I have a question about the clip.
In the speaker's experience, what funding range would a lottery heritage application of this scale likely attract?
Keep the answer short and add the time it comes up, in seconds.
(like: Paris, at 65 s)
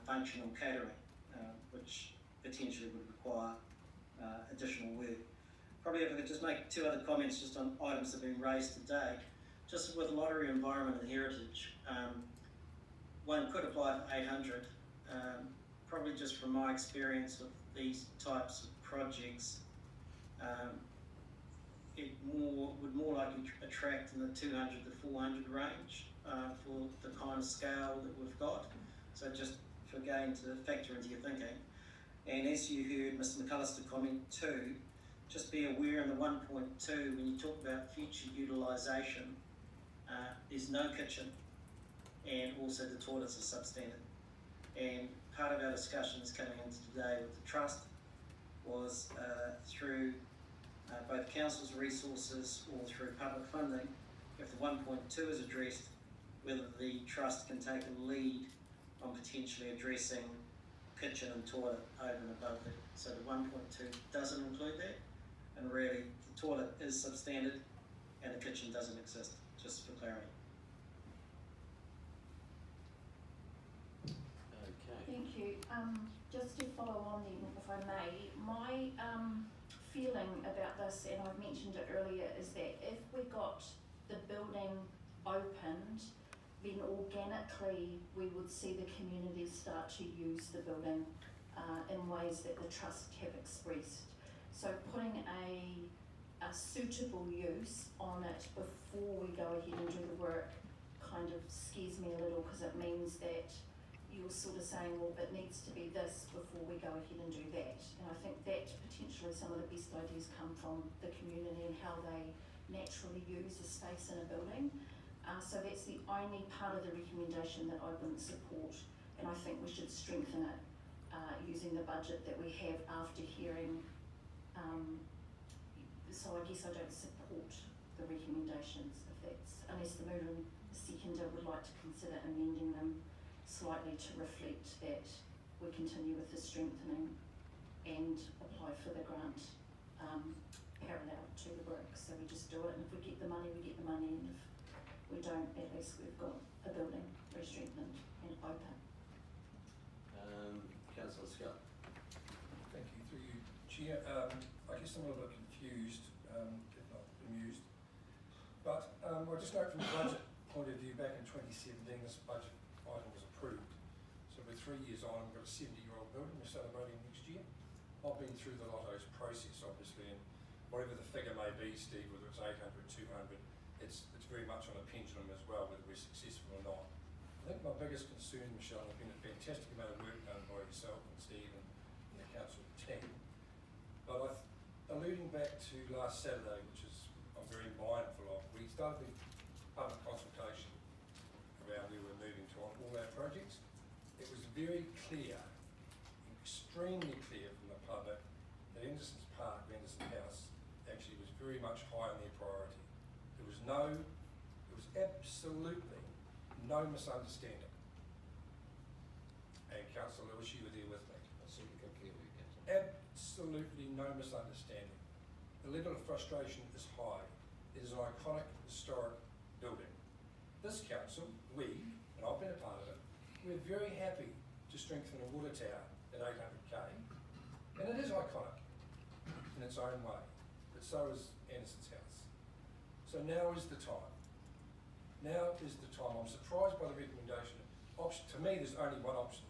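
200 to 400, at 24 s.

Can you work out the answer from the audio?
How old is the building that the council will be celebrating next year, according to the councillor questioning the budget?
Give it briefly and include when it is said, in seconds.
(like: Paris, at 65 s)
70 years, at 165 s.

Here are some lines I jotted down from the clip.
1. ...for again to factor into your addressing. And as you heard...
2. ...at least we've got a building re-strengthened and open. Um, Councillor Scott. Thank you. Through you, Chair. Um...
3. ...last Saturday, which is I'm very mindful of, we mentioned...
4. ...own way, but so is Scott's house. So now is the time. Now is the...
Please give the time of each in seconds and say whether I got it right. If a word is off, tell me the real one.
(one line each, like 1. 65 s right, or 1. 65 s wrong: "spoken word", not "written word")
1. 29 s wrong: "thinking", not "addressing"
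2. 145 s right
3. 185 s wrong: "started", not "mentioned"
4. 229 s wrong: "Anderson", not "Scott".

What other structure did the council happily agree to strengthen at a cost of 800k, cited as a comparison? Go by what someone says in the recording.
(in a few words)
a water tower.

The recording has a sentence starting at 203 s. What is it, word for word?
There was no, there was absolutely no misunderstanding.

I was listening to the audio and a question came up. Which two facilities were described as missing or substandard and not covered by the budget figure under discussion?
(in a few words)
kitchen and toilet.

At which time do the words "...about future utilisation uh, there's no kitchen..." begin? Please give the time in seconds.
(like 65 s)
37 s.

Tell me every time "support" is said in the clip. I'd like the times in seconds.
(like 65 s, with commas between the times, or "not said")
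118 s, 126 s.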